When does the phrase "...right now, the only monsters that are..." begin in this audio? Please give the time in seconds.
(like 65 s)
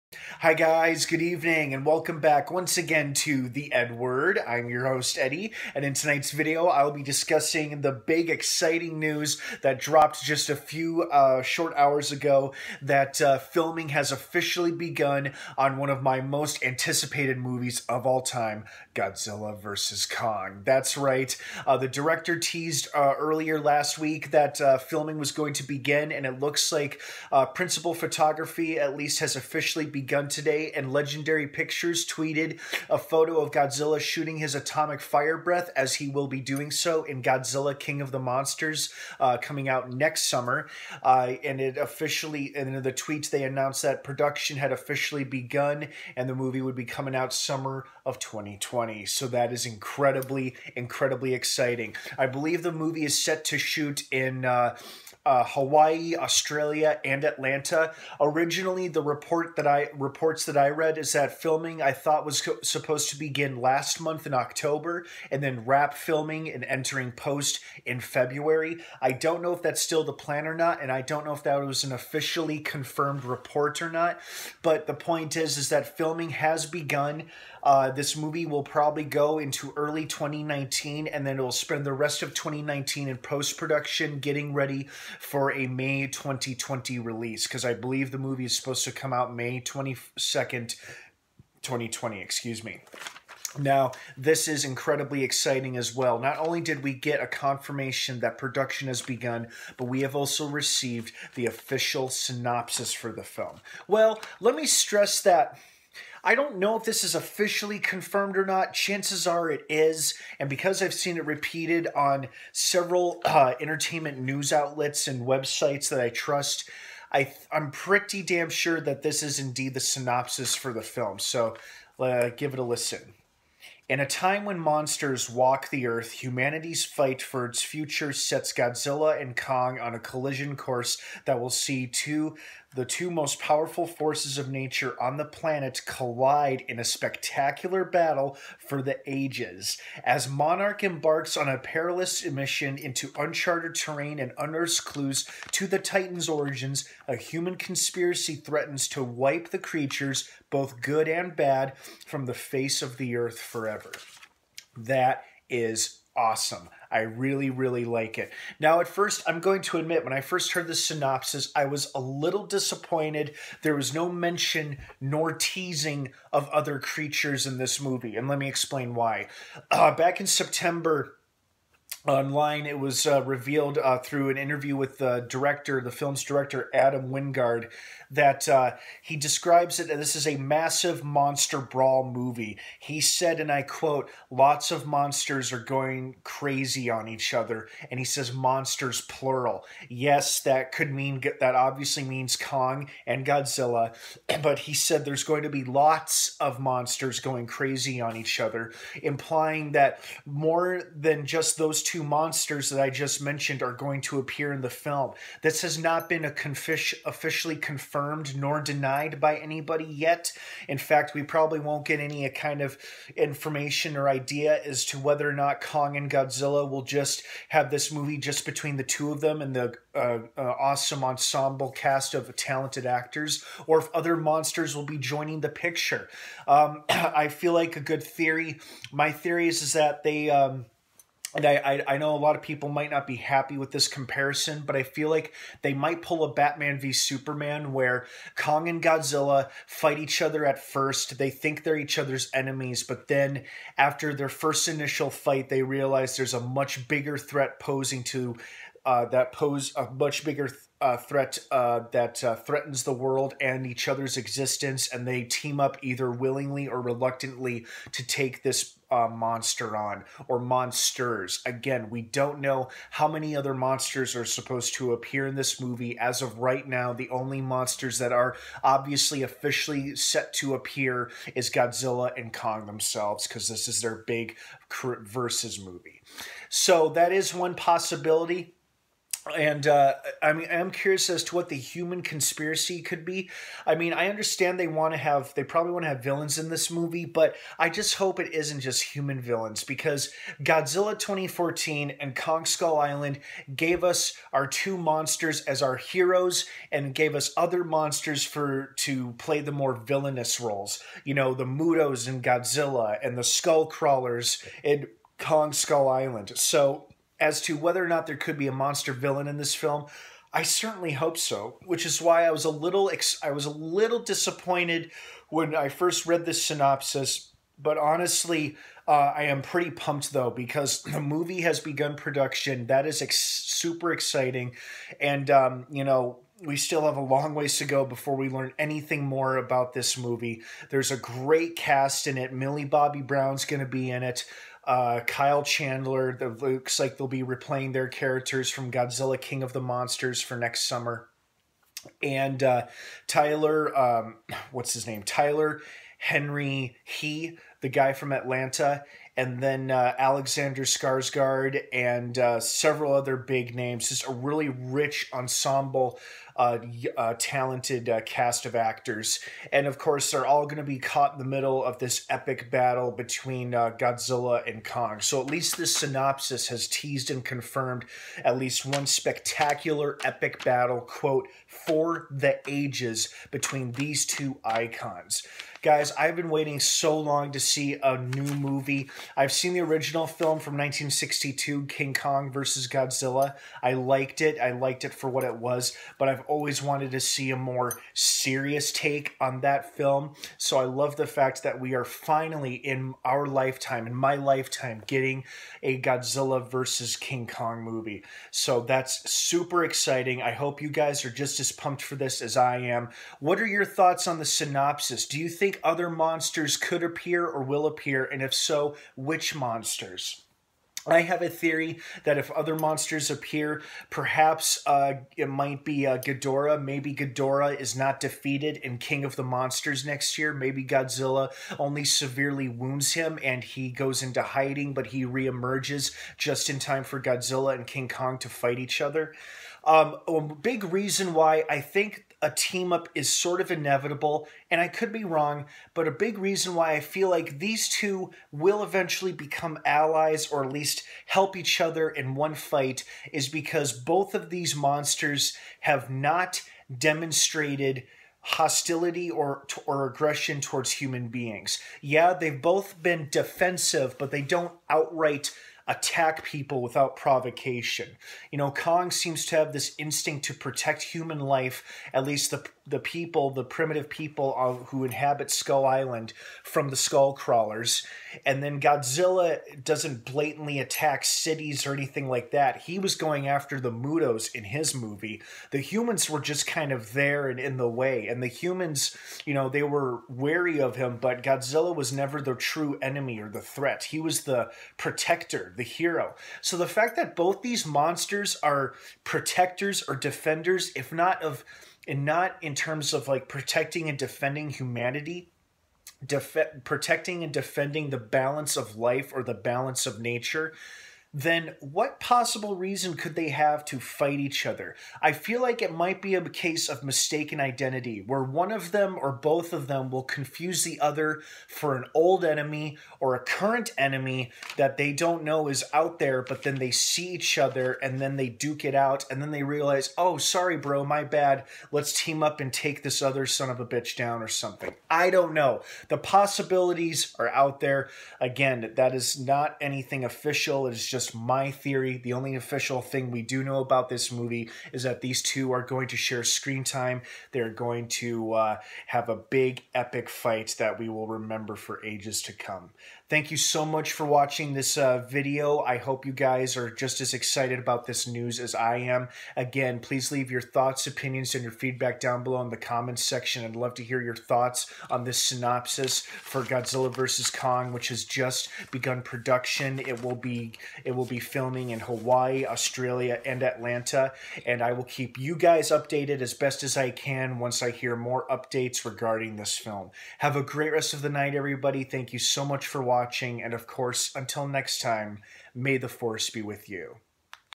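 266 s.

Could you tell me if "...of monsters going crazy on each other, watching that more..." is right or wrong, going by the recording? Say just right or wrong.
wrong.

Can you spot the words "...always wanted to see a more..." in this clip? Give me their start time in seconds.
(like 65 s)
386 s.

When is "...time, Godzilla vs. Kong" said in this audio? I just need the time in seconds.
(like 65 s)
18 s.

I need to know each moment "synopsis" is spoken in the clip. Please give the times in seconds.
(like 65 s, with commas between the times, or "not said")
102 s, 119 s, 160 s, 316 s, 365 s, 404 s, 555 s.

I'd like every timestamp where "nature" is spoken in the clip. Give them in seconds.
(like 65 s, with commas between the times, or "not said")
134 s, 499 s.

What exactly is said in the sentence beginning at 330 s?
There's a great cast in it.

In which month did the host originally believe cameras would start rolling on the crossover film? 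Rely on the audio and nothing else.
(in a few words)
October.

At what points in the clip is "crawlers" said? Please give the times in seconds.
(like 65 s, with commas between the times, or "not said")
303 s, 467 s.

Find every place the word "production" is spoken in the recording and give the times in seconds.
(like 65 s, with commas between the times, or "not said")
44 s, 83 s, 98 s, 321 s, 559 s.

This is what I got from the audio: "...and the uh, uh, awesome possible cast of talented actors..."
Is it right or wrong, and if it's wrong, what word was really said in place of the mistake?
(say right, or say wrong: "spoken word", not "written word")
wrong: "ensemble", not "possible".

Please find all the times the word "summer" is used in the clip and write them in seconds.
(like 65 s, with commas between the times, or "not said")
40 s, 47 s, 340 s.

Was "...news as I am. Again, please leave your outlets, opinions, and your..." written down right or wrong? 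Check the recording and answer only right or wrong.
wrong.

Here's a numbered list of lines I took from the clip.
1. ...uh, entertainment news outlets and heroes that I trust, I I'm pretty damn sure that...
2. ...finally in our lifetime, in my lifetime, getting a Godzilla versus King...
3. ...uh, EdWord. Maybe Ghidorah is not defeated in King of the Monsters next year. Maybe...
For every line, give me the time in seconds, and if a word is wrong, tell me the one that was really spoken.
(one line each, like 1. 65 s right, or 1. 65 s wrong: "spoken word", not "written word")
1. 113 s wrong: "websites", not "heroes"
2. 391 s right
3. 415 s wrong: "Ghidorah", not "EdWord".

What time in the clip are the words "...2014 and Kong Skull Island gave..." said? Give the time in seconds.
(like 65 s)
290 s.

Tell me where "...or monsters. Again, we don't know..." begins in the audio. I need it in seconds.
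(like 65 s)
260 s.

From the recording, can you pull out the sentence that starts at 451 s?
Yeah, they've both been defensive, but they don't outright attack people without provocation.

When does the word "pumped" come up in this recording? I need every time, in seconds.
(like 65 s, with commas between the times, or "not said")
319 s, 401 s.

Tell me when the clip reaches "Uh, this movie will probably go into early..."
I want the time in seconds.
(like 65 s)
77 s.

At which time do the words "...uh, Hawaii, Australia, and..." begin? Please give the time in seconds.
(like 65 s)
55 s.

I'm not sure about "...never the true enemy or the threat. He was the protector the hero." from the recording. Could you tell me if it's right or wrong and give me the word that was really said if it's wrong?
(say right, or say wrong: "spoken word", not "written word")
right.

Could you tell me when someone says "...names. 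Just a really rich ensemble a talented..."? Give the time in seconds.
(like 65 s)
353 s.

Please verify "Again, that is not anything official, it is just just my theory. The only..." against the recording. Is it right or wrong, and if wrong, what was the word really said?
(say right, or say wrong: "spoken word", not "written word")
right.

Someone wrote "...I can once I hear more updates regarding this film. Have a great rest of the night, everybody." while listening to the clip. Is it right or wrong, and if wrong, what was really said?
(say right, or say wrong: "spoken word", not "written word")
right.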